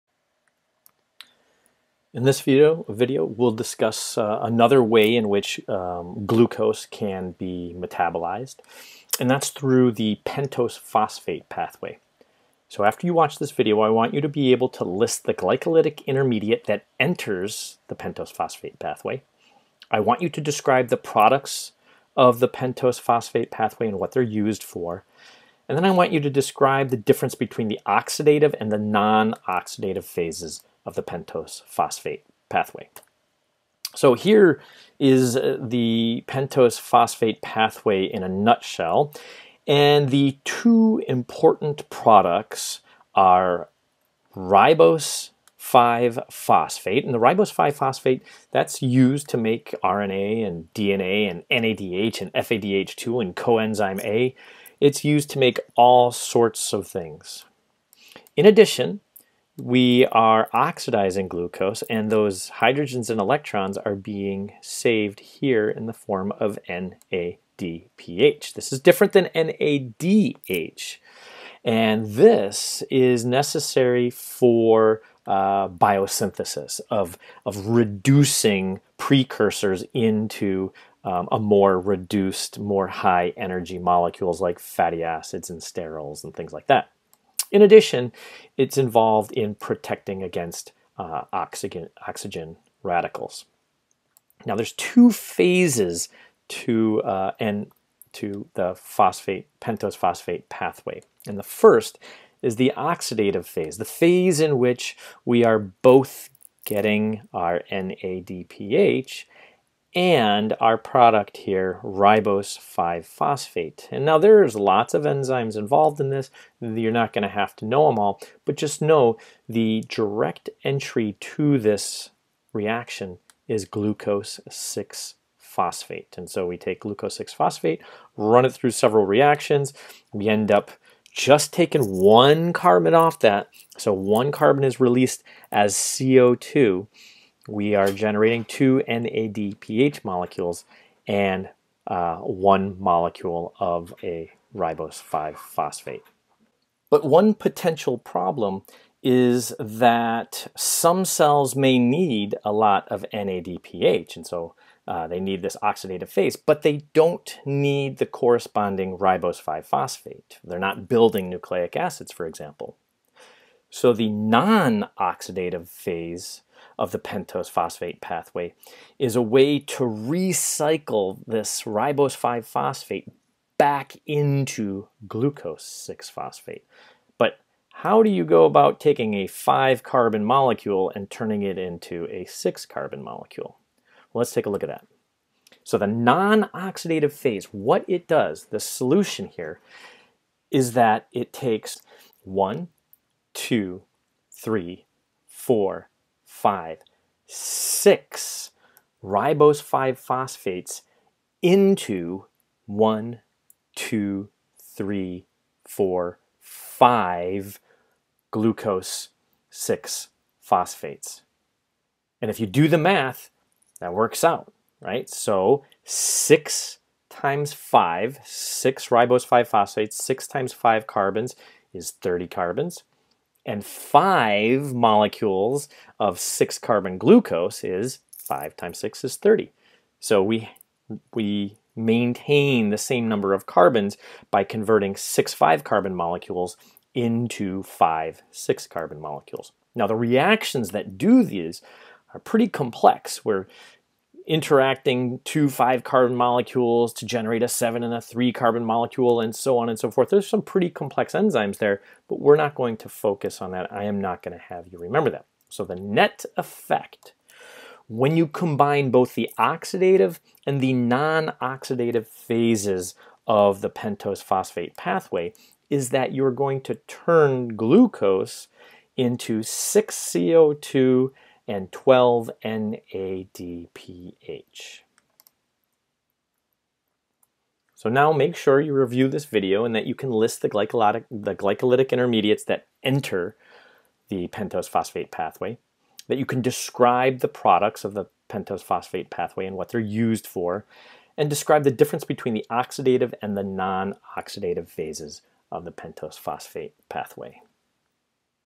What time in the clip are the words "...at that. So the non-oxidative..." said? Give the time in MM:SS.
03:04.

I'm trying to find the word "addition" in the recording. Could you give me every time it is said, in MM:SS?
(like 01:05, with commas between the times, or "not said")
00:58, 01:27.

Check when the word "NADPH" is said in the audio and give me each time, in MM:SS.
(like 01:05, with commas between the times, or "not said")
01:06, 01:47, 02:18, 02:33, 04:32.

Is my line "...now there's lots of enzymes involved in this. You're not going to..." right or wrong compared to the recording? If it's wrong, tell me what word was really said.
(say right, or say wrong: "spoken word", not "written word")
right.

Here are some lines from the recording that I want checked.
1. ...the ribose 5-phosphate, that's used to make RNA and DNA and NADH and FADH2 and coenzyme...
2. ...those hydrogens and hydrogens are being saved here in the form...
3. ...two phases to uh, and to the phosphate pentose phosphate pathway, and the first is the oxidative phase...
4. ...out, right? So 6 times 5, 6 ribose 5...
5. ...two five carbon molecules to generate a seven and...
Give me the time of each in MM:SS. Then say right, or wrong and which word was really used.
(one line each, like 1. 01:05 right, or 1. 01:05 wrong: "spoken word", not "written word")
1. 00:47 right
2. 01:02 wrong: "electrons", not "hydrogens"
3. 01:34 right
4. 03:34 right
5. 04:05 right.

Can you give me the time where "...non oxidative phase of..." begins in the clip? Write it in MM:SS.
02:44.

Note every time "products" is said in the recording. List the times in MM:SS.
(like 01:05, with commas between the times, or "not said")
00:20, 00:41, 01:50, 04:47.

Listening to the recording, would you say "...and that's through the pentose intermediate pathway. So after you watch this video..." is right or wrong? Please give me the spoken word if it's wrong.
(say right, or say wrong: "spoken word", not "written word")
wrong: "phosphate", not "intermediate".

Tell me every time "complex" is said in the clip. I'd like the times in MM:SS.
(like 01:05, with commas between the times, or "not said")
04:02, 04:10.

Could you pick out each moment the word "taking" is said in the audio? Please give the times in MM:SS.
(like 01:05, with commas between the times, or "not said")
02:11, 02:58.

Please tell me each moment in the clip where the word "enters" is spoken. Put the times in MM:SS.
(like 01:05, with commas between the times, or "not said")
00:16, 04:42.